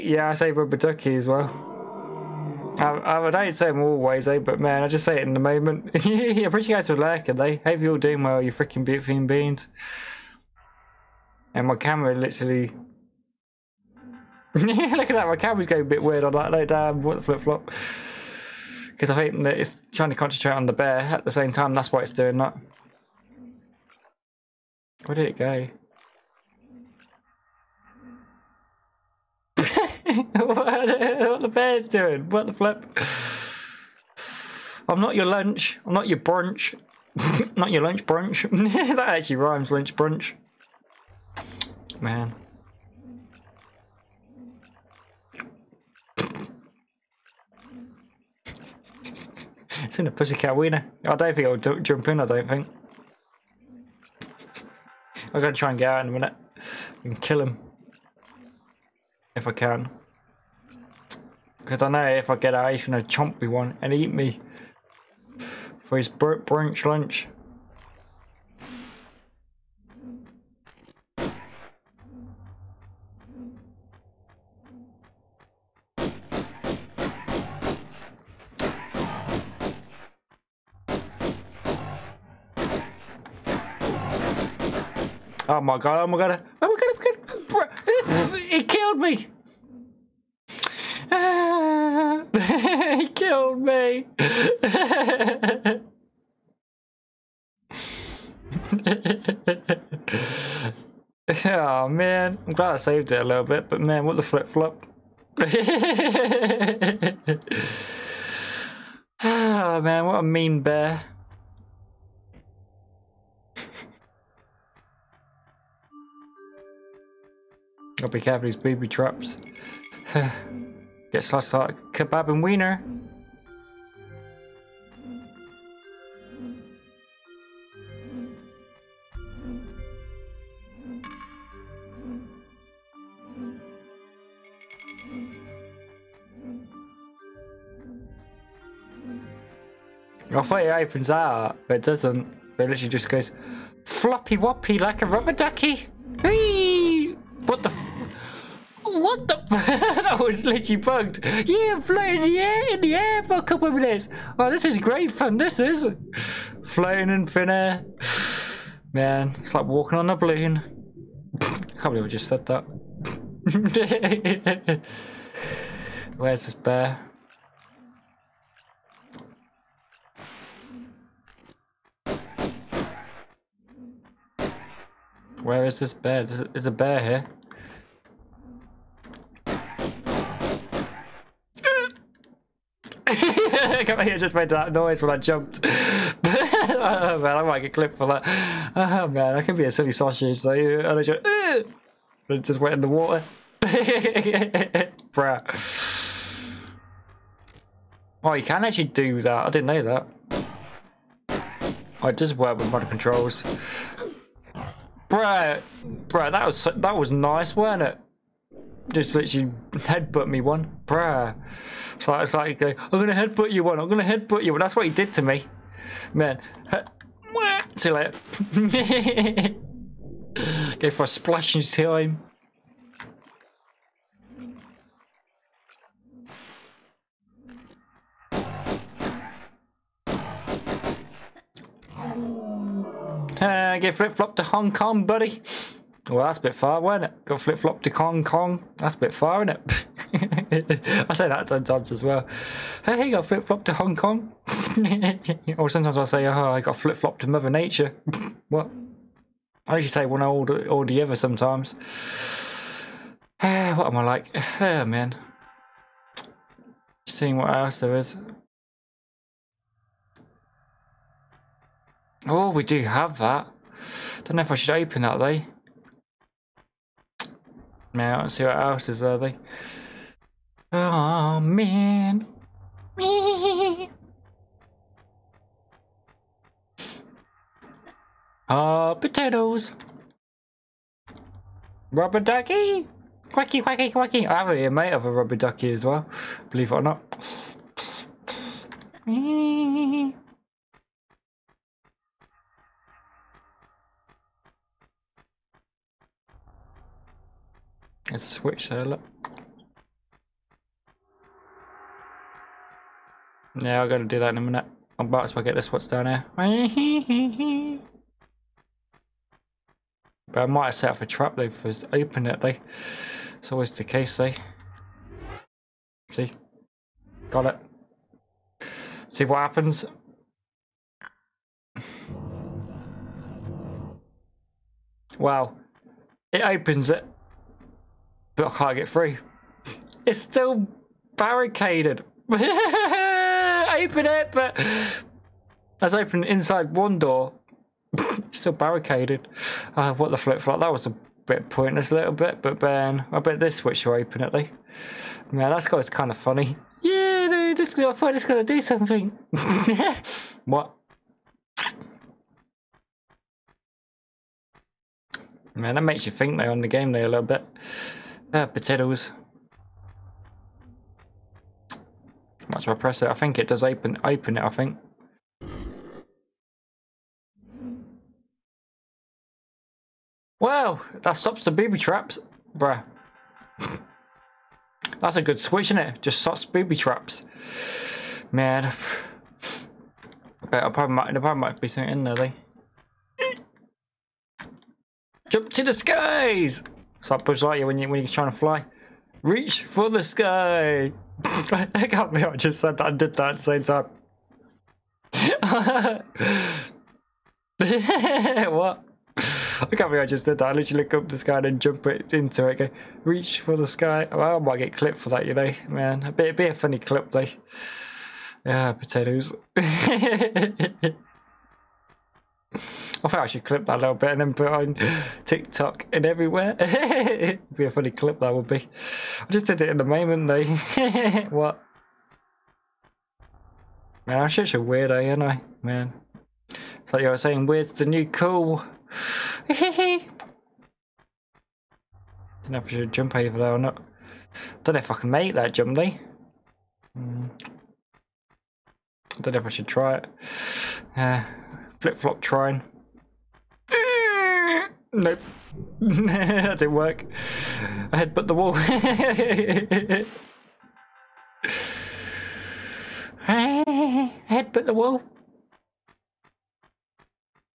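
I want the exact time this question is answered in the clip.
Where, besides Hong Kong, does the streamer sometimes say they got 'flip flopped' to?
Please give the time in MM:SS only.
04:07.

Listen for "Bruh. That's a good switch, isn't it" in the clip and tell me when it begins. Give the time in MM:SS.
06:12.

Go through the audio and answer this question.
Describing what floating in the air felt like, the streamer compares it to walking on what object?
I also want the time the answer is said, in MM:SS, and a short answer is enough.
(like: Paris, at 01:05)
a balloon, at 02:40.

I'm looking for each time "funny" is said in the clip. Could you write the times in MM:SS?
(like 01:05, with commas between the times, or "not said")
05:46, 06:46, 06:57.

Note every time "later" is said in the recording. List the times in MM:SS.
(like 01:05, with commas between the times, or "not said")
03:37.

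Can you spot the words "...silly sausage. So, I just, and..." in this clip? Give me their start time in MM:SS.
03:09.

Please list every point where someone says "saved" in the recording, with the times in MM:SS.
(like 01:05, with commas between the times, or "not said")
01:42.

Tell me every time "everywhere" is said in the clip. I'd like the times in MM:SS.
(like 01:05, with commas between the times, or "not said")
06:56.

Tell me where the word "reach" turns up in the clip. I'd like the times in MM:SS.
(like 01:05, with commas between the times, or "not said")
06:29, 06:43.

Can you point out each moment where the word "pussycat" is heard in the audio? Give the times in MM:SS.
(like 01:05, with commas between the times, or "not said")
00:50.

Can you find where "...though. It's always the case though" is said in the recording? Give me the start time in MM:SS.
05:12.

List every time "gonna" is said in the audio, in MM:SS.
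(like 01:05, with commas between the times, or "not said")
00:55, 01:02, 05:48.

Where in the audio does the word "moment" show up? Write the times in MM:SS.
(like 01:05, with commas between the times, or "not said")
00:05, 06:59.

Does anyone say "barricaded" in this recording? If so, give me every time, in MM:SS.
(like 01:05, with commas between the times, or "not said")
05:31, 05:38.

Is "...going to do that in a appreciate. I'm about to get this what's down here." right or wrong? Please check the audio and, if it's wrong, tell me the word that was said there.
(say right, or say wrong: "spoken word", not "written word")
wrong: "minute", not "appreciate".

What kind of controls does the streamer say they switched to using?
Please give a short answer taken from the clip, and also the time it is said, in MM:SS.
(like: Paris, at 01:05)
modern controls, at 03:22.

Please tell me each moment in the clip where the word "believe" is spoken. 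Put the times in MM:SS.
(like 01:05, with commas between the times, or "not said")
02:41, 04:46, 06:39.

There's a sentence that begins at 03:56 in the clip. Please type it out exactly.
Well, that's a bit far, wasn't it?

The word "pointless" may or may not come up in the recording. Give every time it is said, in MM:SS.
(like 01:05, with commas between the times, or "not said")
05:41.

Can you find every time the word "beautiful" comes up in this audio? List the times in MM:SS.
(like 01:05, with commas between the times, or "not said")
00:08.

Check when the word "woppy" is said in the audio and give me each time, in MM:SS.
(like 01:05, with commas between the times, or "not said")
02:24.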